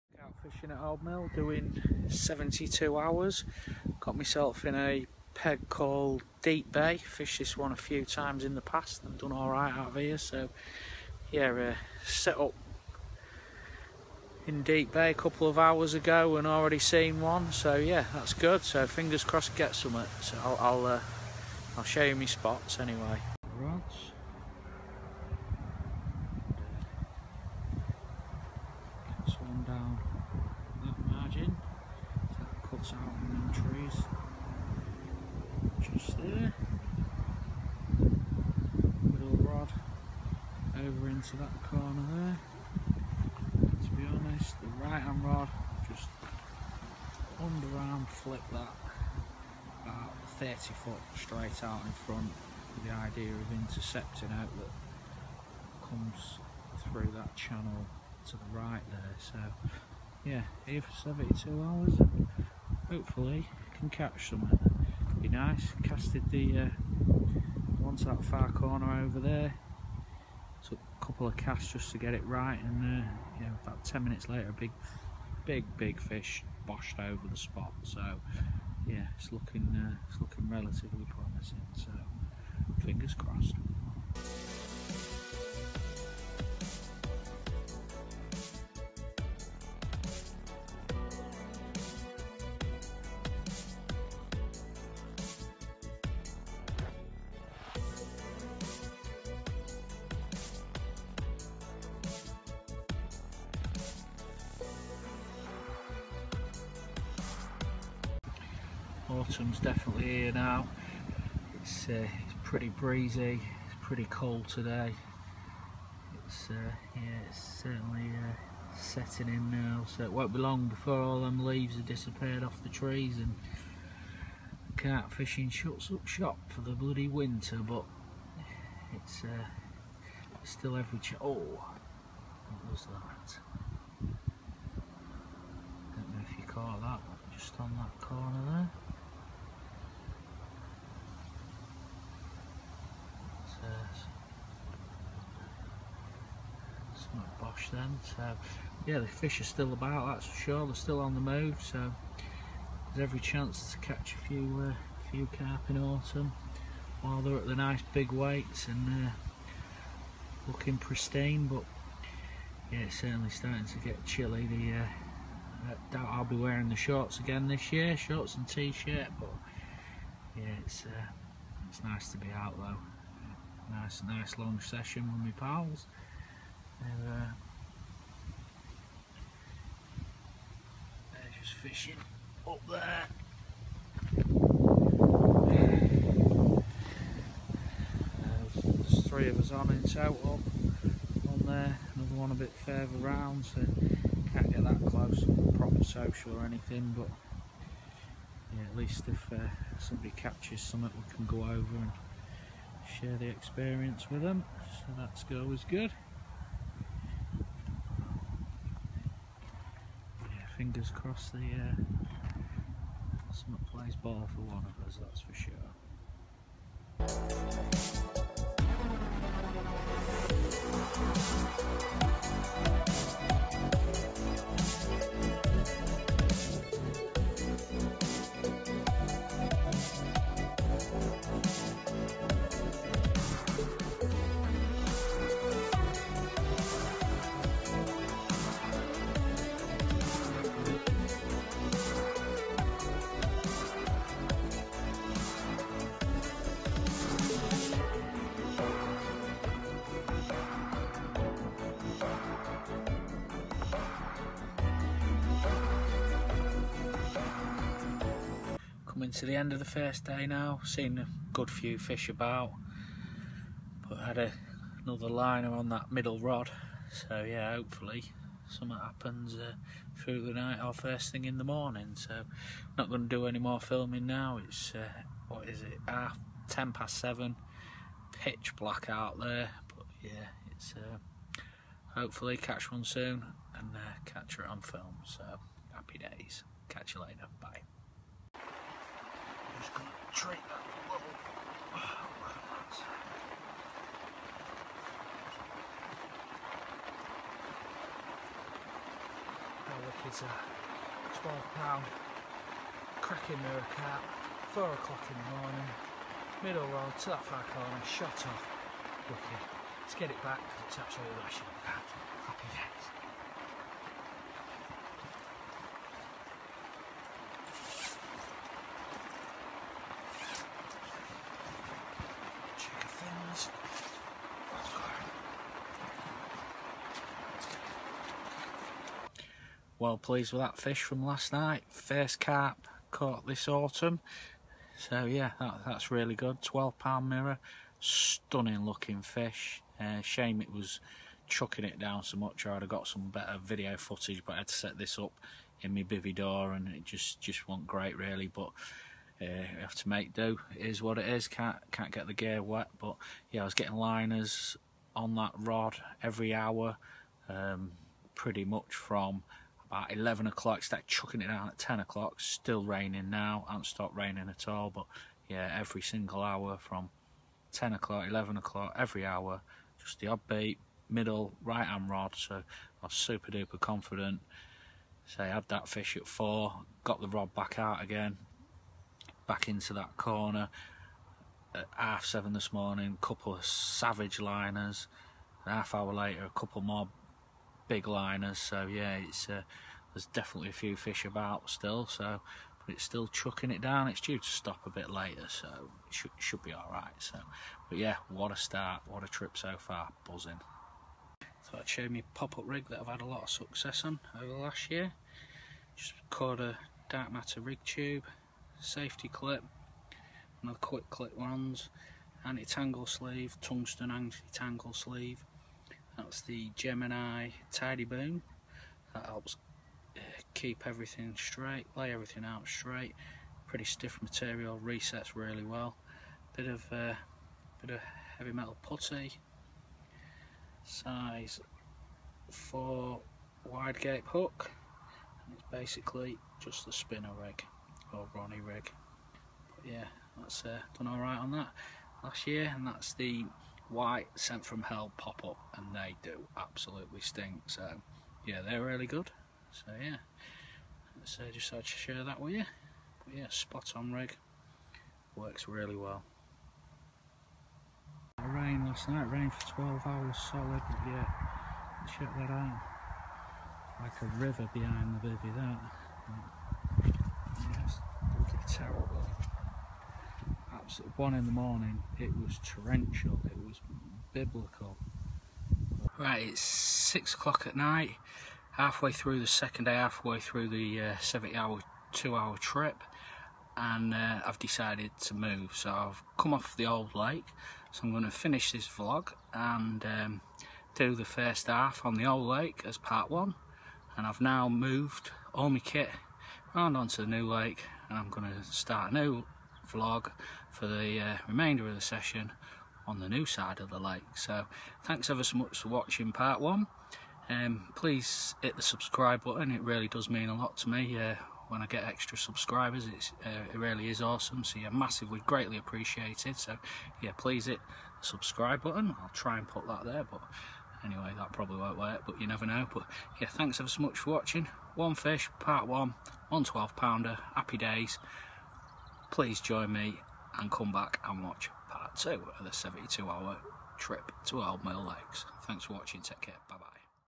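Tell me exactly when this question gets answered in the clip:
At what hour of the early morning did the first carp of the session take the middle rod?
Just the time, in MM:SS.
05:04.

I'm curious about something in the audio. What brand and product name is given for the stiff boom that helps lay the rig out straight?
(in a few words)
Gemini Tidy Boom.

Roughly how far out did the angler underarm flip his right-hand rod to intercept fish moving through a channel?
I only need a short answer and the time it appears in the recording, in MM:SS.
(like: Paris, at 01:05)
30 feet, at 00:50.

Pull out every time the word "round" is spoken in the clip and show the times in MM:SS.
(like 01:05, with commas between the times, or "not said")
03:12, 08:16.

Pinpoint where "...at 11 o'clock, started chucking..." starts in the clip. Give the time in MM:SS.
05:59.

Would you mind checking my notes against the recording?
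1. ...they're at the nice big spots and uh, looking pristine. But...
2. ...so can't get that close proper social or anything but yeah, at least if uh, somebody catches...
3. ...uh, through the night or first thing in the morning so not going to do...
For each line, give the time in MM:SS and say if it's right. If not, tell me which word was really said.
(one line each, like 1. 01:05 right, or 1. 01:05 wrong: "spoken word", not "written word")
1. 02:37 wrong: "weights", not "spots"
2. 03:13 right
3. 04:29 right.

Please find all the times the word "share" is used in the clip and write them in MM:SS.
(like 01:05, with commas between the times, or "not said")
03:22, 07:31.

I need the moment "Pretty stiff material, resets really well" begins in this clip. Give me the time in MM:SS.
07:03.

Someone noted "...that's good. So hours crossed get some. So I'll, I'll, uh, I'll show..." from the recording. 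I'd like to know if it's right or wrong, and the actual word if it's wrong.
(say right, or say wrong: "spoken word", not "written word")
wrong: "fingers", not "hours".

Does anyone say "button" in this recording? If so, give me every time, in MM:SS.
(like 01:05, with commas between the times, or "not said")
08:29, 08:38.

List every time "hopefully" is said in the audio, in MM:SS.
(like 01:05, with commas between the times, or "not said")
01:02, 04:27, 04:41.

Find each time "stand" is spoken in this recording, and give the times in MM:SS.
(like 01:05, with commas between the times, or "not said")
not said.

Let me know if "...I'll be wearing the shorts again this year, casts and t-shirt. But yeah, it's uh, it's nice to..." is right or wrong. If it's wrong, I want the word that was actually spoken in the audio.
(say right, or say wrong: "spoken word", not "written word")
wrong: "shorts", not "casts".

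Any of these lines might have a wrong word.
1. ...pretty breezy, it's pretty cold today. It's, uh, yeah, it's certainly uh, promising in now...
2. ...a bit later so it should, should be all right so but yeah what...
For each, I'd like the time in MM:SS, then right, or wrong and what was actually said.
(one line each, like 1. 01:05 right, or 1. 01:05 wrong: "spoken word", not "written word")
1. 01:52 wrong: "setting", not "promising"
2. 06:34 right.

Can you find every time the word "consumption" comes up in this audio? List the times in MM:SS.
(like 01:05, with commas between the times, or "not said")
not said.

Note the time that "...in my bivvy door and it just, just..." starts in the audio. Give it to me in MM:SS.
05:45.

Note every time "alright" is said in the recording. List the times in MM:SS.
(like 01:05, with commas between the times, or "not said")
00:09.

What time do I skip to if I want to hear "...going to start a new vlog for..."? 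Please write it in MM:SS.
08:18.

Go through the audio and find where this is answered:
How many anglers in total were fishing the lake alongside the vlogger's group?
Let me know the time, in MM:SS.
03:09.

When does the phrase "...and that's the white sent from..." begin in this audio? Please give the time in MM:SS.
07:22.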